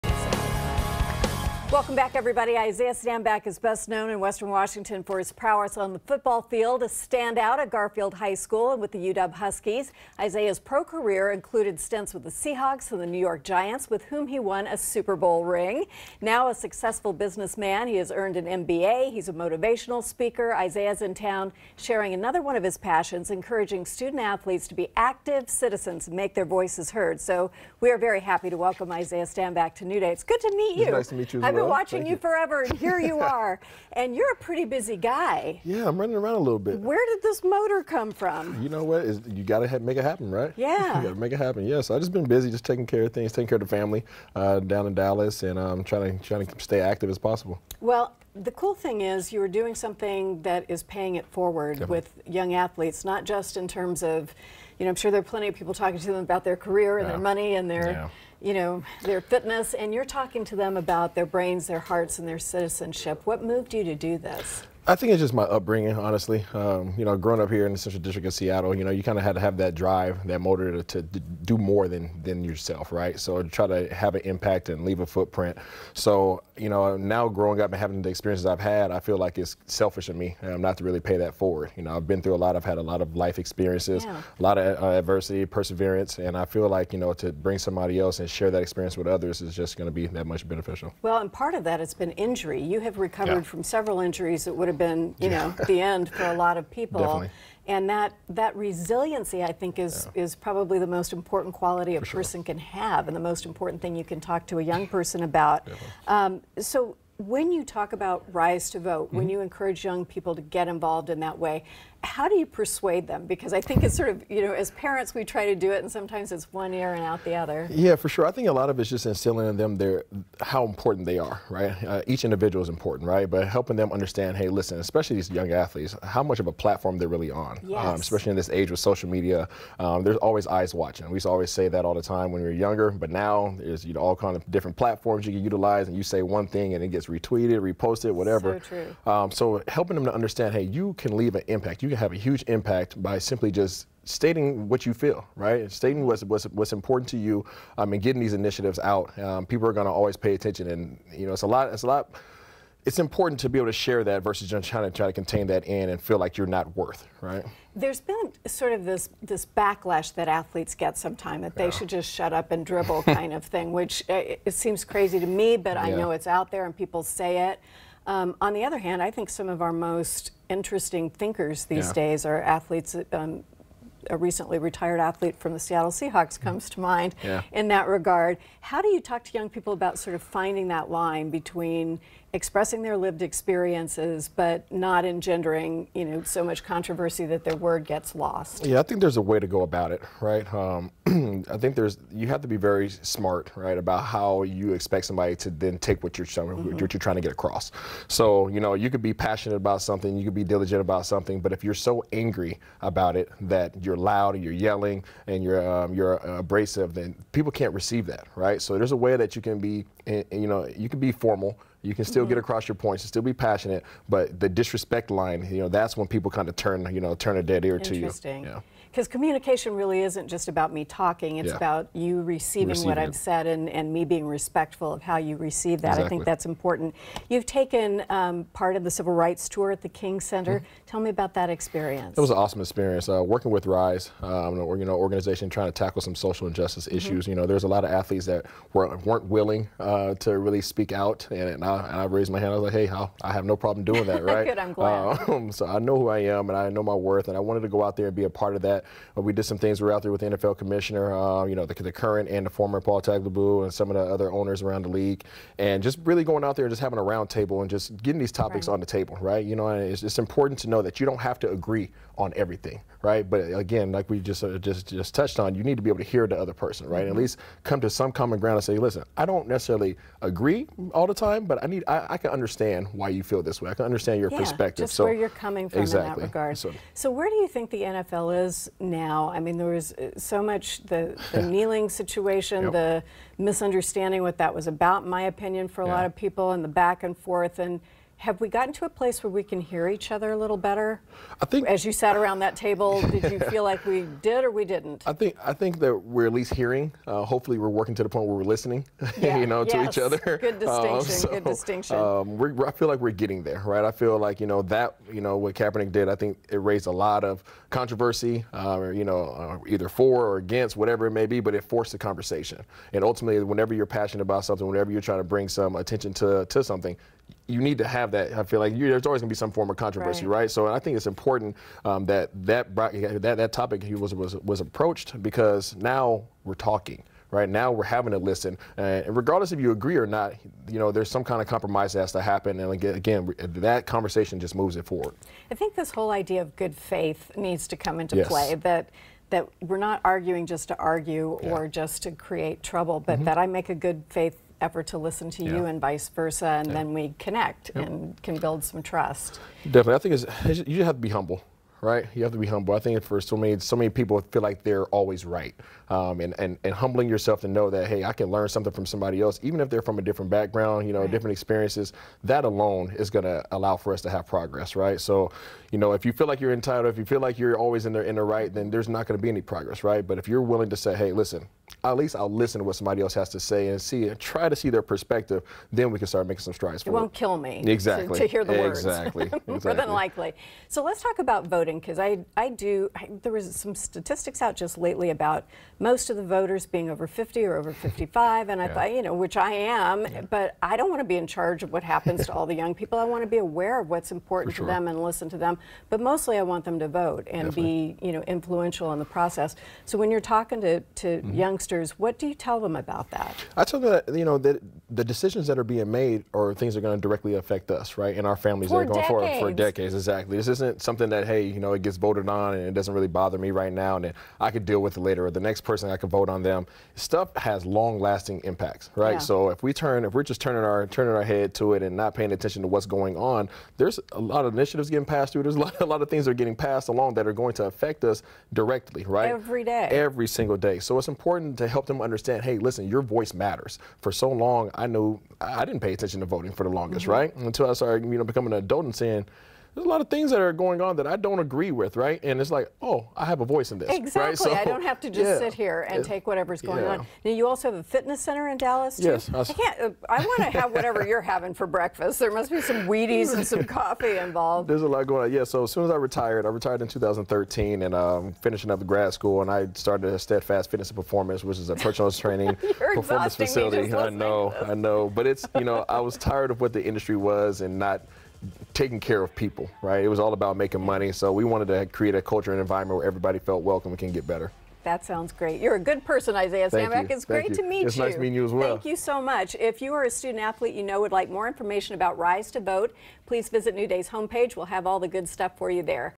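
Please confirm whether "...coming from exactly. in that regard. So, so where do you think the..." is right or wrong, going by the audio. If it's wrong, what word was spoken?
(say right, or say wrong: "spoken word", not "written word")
right.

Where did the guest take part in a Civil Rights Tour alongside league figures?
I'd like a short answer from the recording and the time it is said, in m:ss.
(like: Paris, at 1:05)
King Center, at 3:49.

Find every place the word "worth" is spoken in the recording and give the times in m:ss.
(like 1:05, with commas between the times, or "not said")
2:36, 4:07.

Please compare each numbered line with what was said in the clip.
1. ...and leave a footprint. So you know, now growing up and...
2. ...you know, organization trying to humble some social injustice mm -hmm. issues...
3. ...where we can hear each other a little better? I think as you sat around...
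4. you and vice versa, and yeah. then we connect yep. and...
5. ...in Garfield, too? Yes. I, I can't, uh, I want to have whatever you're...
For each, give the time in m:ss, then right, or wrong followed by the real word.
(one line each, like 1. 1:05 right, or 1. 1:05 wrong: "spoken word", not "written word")
1. 1:14 right
2. 3:54 wrong: "tackle", not "humble"
3. 4:49 right
4. 5:45 right
5. 7:28 wrong: "Dallas", not "Garfield".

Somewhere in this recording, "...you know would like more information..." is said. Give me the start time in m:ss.
8:00.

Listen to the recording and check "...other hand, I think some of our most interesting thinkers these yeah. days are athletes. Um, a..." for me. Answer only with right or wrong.
right.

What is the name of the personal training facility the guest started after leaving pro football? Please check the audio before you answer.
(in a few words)
Steadfast Fitness and Performance.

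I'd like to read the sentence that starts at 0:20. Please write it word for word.
Isaiah's in town sharing another one of his passions, encouraging student athletes to be active citizens and make their voices heard.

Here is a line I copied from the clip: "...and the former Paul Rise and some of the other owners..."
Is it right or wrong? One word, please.
wrong.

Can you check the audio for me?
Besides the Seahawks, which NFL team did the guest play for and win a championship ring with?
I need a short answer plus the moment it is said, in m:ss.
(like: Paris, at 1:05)
New York Giants, at 0:13.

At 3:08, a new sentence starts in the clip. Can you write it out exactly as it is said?
Yeah, I think there's a way to go about it, right?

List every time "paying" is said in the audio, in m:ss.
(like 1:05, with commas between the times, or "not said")
0:50, 7:02.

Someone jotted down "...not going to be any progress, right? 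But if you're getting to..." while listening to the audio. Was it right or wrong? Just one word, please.
wrong.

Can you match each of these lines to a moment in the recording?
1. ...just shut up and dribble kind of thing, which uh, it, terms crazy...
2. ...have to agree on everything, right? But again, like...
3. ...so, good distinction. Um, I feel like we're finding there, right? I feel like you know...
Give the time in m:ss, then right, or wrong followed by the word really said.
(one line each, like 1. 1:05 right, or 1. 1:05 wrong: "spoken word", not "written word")
1. 2:41 wrong: "seems", not "terms"
2. 4:21 right
3. 5:01 wrong: "getting", not "finding".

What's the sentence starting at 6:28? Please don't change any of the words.
I thought you know which I am, yeah.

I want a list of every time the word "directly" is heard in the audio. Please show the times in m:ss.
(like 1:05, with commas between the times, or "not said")
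6:47, 7:08.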